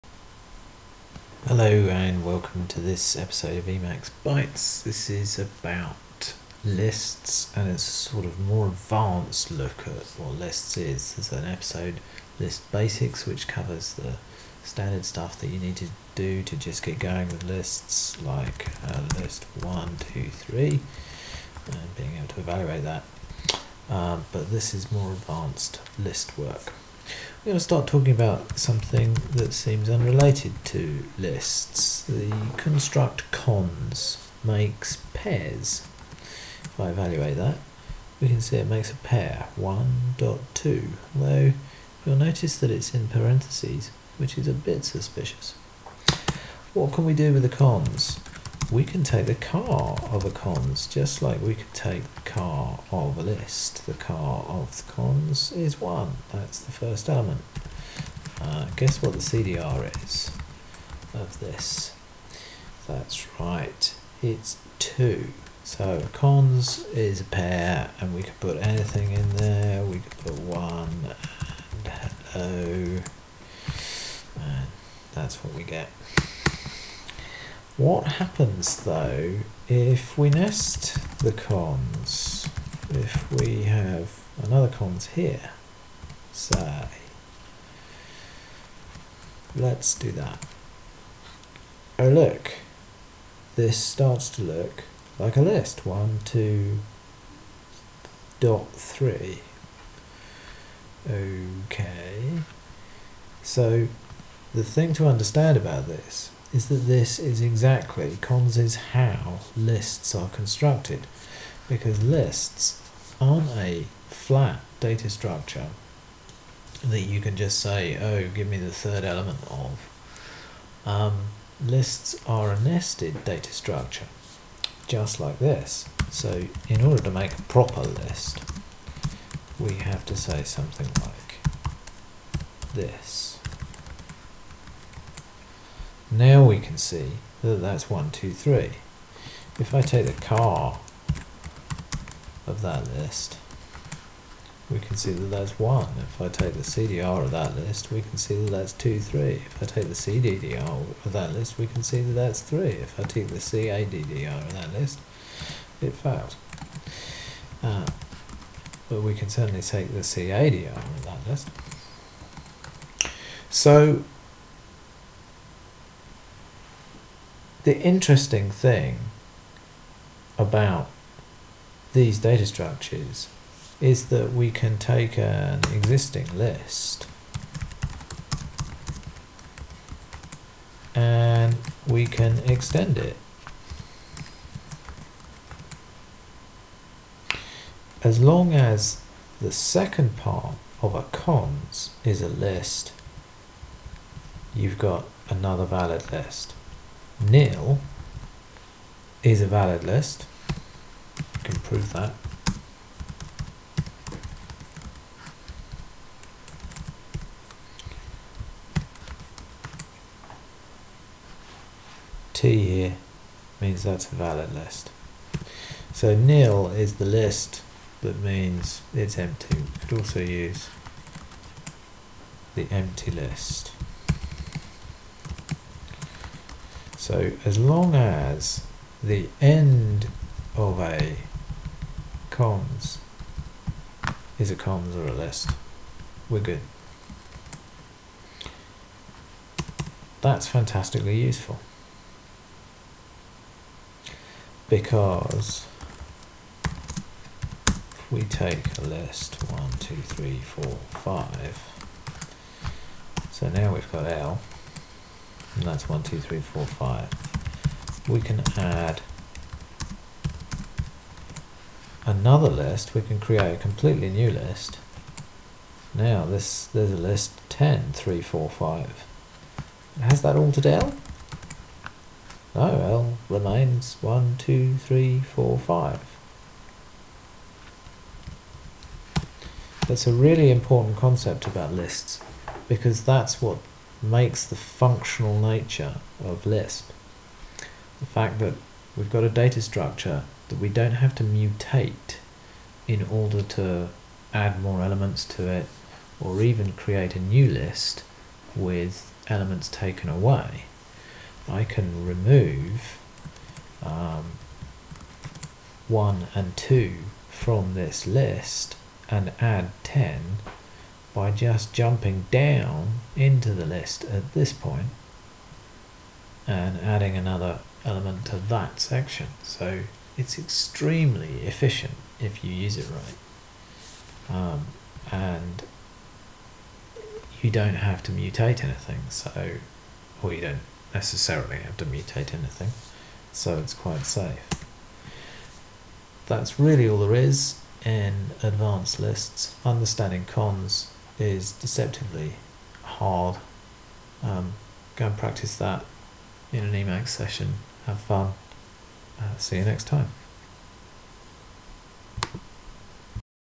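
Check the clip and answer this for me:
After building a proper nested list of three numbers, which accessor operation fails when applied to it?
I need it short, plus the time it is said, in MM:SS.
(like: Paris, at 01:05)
CADDR, at 02:33.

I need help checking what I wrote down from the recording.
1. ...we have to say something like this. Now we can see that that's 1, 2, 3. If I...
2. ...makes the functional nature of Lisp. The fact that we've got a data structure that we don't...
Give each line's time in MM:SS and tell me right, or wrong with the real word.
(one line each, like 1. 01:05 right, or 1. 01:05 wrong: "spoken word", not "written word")
1. 02:09 right
2. 04:44 right.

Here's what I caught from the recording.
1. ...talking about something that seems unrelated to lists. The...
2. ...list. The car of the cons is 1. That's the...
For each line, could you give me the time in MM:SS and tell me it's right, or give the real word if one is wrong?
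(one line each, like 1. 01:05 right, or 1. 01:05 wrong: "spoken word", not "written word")
1. 00:27 right
2. 00:53 right.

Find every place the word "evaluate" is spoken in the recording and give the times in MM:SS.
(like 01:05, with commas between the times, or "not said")
00:22, 00:36.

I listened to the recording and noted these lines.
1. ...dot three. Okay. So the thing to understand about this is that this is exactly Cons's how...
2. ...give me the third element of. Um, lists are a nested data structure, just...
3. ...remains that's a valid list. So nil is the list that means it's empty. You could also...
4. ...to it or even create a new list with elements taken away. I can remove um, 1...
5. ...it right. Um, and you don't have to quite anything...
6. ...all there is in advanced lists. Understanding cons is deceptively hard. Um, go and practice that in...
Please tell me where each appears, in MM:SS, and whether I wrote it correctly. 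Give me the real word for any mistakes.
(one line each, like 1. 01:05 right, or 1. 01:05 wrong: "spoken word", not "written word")
1. 01:38 right
2. 01:58 right
3. 03:33 wrong: "means", not "remains"
4. 04:55 right
5. 05:22 wrong: "mutate", not "quite"
6. 05:36 right.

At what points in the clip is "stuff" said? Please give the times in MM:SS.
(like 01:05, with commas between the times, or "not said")
00:15.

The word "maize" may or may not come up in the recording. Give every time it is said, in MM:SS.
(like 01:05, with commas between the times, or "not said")
not said.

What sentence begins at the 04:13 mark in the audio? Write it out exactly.
So now we've got L and that's one, two, three, four, five.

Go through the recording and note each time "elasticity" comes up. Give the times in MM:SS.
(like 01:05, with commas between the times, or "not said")
not said.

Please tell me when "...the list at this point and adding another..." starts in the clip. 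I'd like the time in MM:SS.
05:13.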